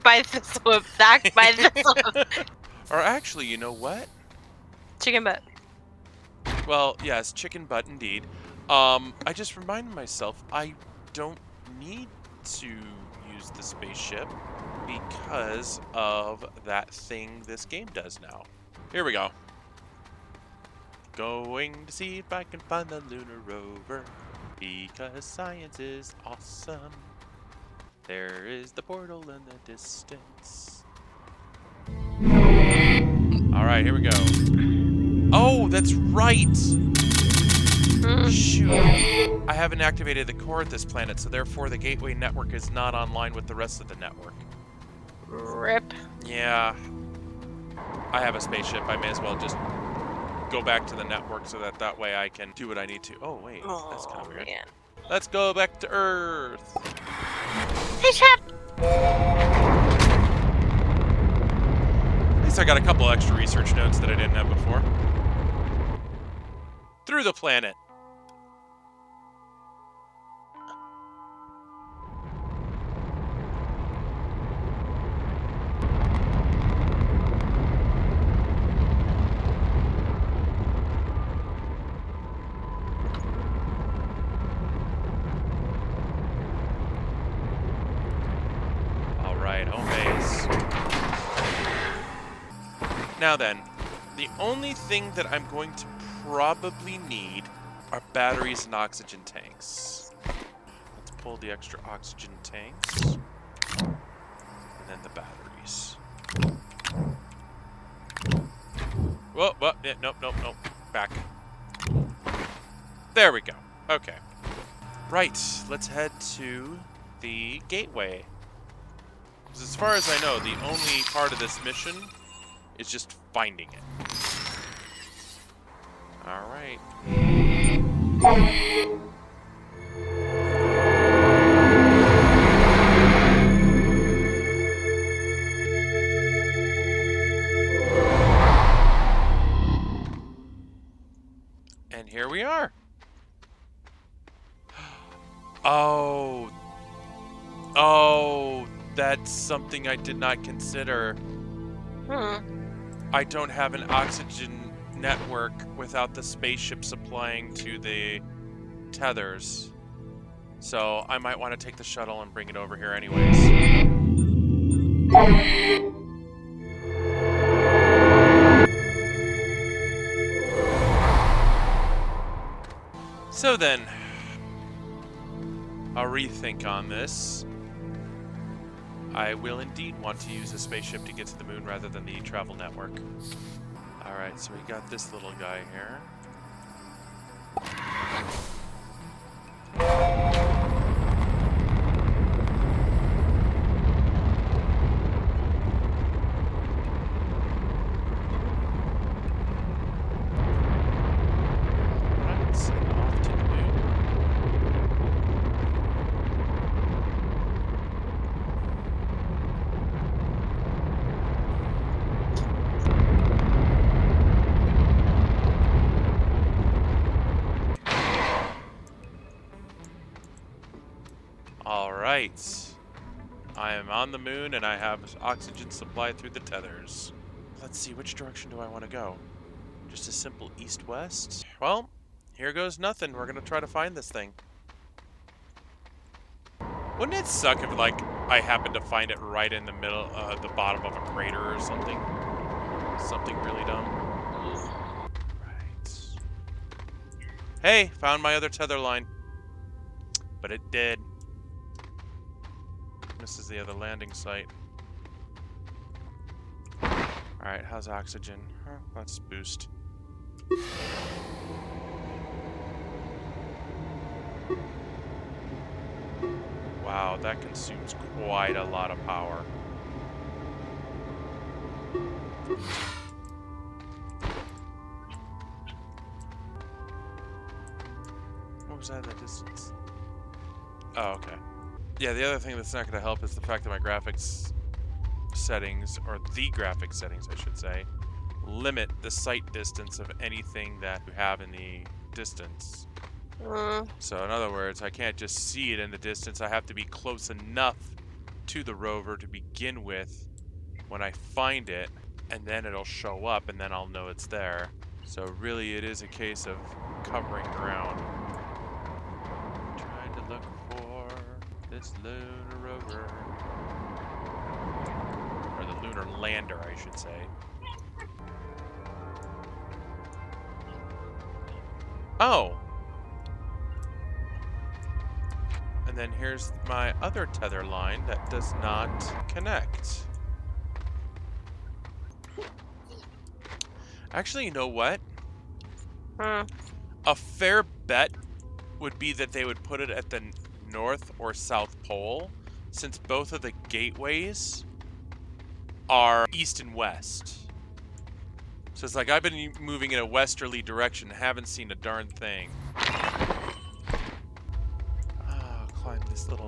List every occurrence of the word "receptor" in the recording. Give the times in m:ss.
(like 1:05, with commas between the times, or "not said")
not said.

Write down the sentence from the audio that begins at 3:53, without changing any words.
We're going to try to find this thing.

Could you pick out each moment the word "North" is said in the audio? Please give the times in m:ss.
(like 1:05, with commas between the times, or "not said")
5:40.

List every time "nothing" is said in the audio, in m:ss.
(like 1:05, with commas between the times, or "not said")
3:52.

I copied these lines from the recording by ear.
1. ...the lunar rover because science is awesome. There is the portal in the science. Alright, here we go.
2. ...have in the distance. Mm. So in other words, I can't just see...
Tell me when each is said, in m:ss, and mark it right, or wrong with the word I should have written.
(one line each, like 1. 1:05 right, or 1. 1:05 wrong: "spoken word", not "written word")
1. 0:22 wrong: "distance", not "science"
2. 4:51 right.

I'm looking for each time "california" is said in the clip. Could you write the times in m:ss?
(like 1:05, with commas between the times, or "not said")
not said.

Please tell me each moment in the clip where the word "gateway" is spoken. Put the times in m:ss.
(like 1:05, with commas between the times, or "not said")
0:41, 1:57, 5:43.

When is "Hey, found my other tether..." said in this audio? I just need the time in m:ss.
4:07.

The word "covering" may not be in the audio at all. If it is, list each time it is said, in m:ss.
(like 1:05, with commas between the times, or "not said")
5:07.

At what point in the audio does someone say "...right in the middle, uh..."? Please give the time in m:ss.
3:59.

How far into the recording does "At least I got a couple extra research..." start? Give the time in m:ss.
1:02.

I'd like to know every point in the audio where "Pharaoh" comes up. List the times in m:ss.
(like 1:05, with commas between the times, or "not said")
not said.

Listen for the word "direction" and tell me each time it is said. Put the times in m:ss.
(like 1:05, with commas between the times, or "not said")
3:48, 5:50.